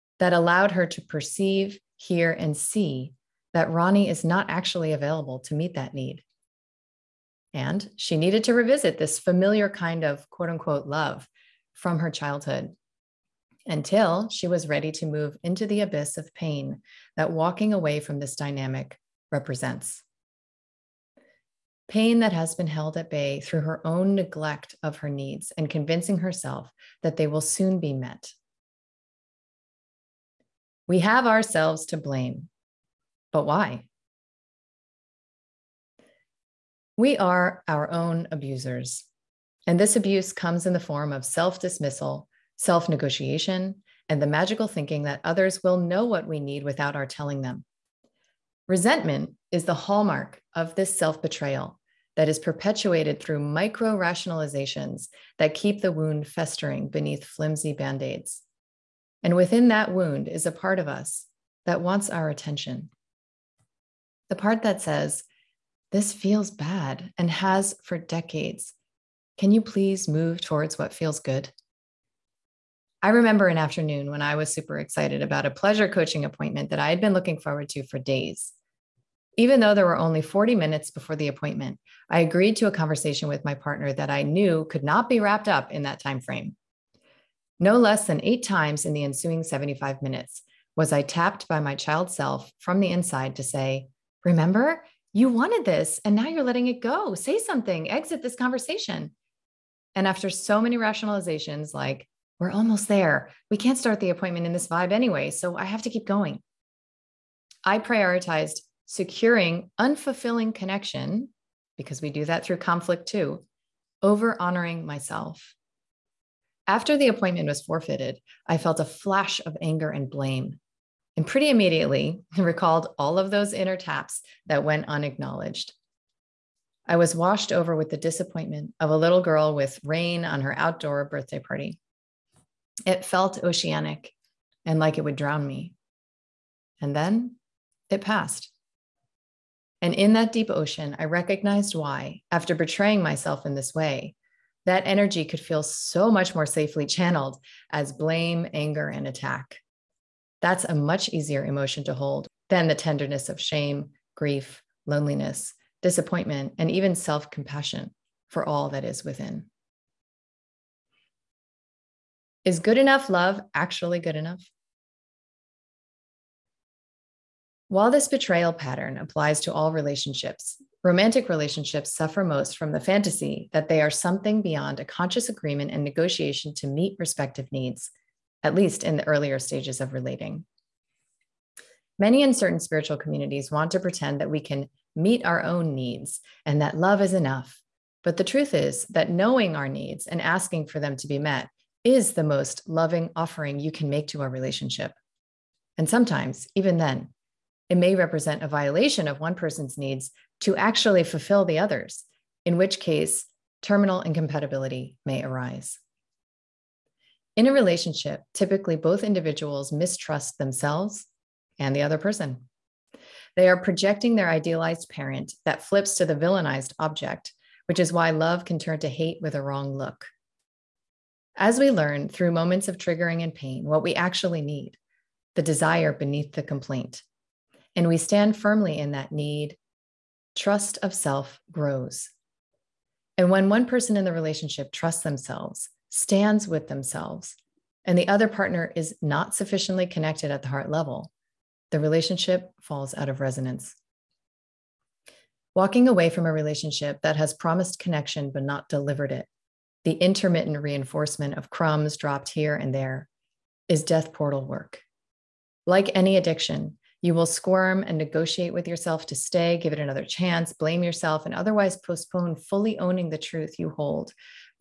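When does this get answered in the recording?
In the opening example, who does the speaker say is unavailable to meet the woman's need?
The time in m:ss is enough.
0:03.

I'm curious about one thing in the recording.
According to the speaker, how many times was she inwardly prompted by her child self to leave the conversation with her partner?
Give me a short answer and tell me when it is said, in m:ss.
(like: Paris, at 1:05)
8, at 1:28.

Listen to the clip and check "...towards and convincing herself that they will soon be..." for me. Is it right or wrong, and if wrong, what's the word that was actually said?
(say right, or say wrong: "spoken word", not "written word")
wrong: "needs", not "towards".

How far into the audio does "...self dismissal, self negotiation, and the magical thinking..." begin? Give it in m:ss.
0:41.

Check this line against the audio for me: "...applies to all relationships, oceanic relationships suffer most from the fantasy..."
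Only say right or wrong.
wrong.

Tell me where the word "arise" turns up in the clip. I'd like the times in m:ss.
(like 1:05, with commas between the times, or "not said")
3:25.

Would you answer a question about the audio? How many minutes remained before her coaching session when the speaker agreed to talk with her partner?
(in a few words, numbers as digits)
40.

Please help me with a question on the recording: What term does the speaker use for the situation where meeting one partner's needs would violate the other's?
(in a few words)
terminal incompatibility.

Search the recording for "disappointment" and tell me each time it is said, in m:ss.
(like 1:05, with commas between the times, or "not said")
2:07, 2:35.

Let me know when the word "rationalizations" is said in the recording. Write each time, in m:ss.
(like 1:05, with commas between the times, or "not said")
0:53, 1:40.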